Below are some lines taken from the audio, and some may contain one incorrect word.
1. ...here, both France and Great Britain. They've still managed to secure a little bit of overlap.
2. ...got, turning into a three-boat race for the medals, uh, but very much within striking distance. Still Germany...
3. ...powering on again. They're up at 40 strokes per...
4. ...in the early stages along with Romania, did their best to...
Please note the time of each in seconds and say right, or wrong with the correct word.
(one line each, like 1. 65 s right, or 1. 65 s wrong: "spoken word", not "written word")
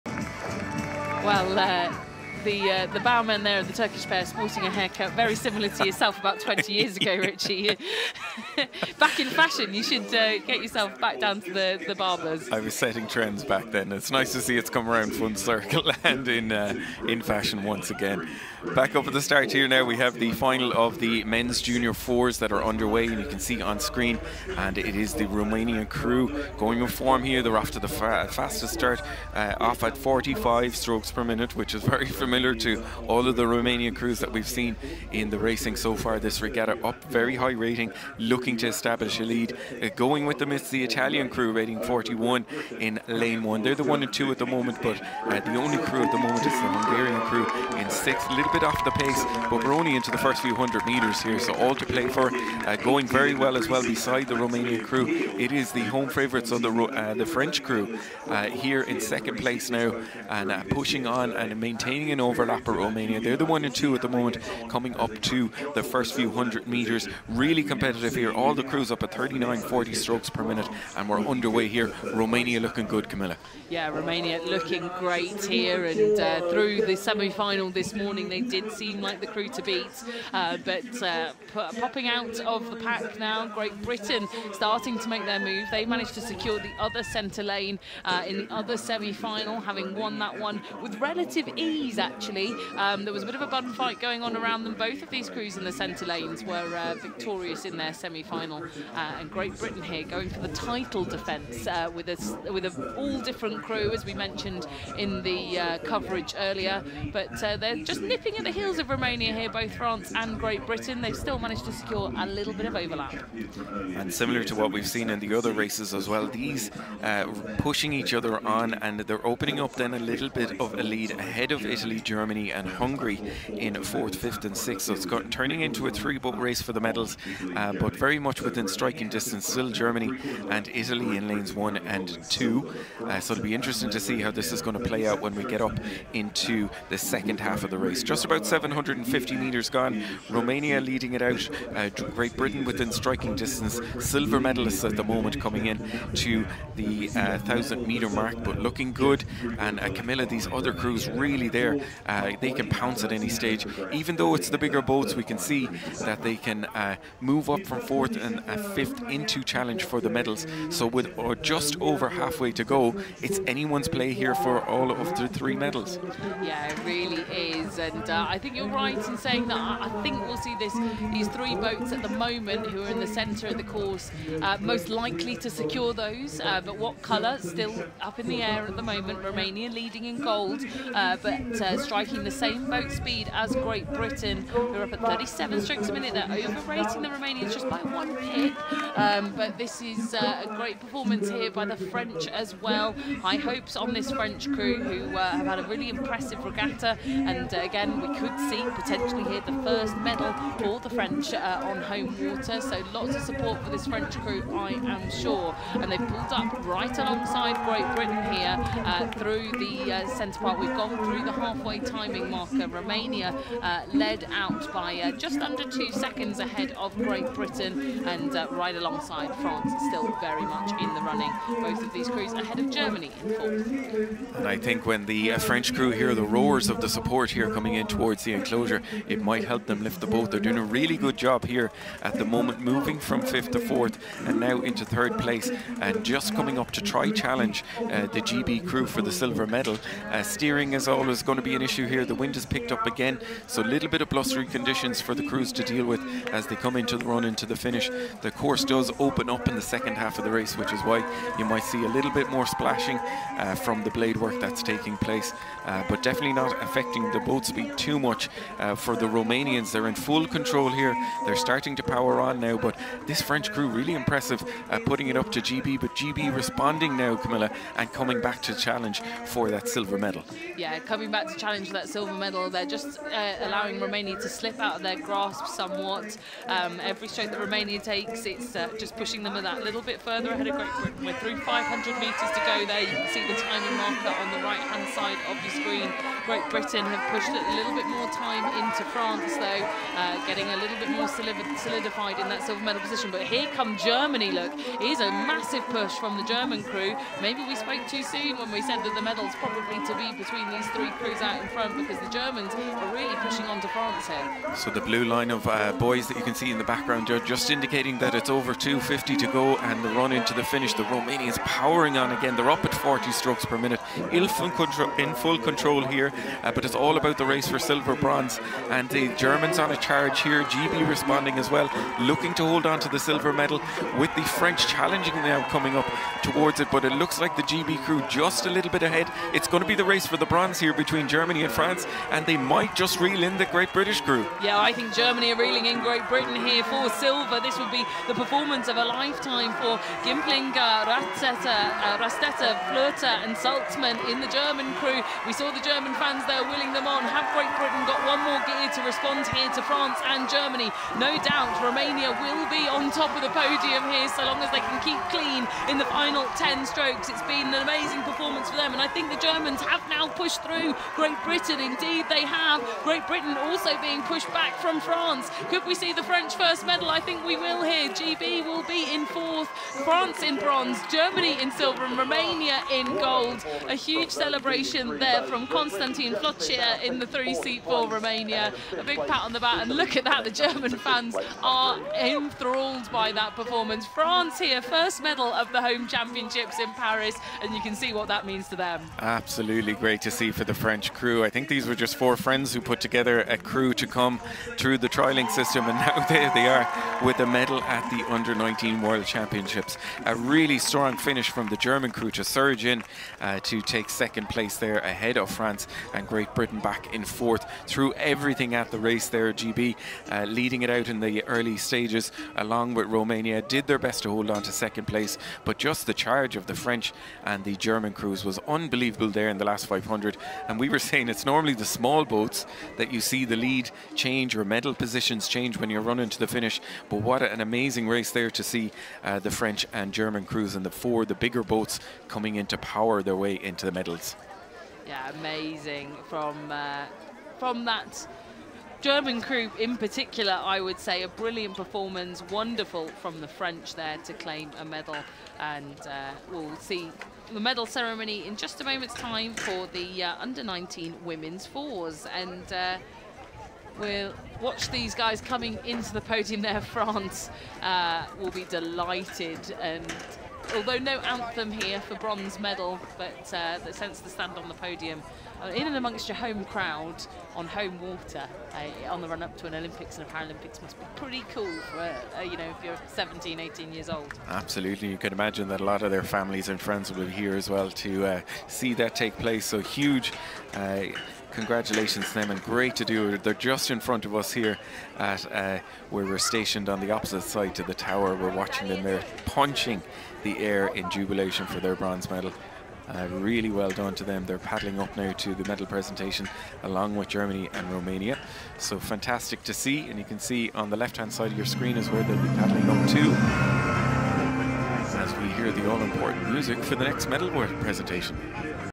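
1. 109 s right
2. 125 s right
3. 311 s right
4. 410 s right.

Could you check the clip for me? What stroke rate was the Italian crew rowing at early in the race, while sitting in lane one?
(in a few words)
41.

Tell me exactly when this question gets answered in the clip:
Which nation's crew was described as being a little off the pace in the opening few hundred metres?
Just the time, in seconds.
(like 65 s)
46 s.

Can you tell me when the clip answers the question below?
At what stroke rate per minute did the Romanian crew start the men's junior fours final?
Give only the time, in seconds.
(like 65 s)
29 s.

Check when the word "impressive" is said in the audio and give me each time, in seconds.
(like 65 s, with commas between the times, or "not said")
195 s, 263 s.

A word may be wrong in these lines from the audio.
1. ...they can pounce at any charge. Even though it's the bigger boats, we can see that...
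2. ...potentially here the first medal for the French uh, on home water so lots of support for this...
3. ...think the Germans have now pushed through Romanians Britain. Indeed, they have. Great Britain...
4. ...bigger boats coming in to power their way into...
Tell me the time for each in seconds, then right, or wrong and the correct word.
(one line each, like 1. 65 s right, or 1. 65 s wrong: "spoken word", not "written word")
1. 152 s wrong: "stage", not "charge"
2. 198 s right
3. 358 s wrong: "Great", not "Romanians"
4. 431 s right.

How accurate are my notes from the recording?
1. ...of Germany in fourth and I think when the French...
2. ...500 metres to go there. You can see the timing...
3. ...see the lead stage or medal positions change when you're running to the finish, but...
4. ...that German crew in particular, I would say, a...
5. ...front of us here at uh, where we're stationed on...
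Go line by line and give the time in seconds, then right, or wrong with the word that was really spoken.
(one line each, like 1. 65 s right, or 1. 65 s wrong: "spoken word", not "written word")
1. 222 s right
2. 281 s right
3. 423 s wrong: "change", not "stage"
4. 437 s right
5. 483 s right.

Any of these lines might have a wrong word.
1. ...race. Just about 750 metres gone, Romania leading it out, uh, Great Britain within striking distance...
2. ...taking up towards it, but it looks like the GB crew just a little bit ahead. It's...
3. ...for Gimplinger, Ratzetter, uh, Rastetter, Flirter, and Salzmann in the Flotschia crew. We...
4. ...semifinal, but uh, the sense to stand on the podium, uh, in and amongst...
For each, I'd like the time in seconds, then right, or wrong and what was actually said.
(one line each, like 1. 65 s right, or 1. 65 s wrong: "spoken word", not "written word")
1. 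137 s right
2. 325 s wrong: "coming", not "taking"
3. 339 s wrong: "German", not "Flotschia"
4. 462 s wrong: "medal", not "semifinal".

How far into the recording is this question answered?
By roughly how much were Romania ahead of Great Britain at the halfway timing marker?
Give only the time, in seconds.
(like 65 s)
215 s.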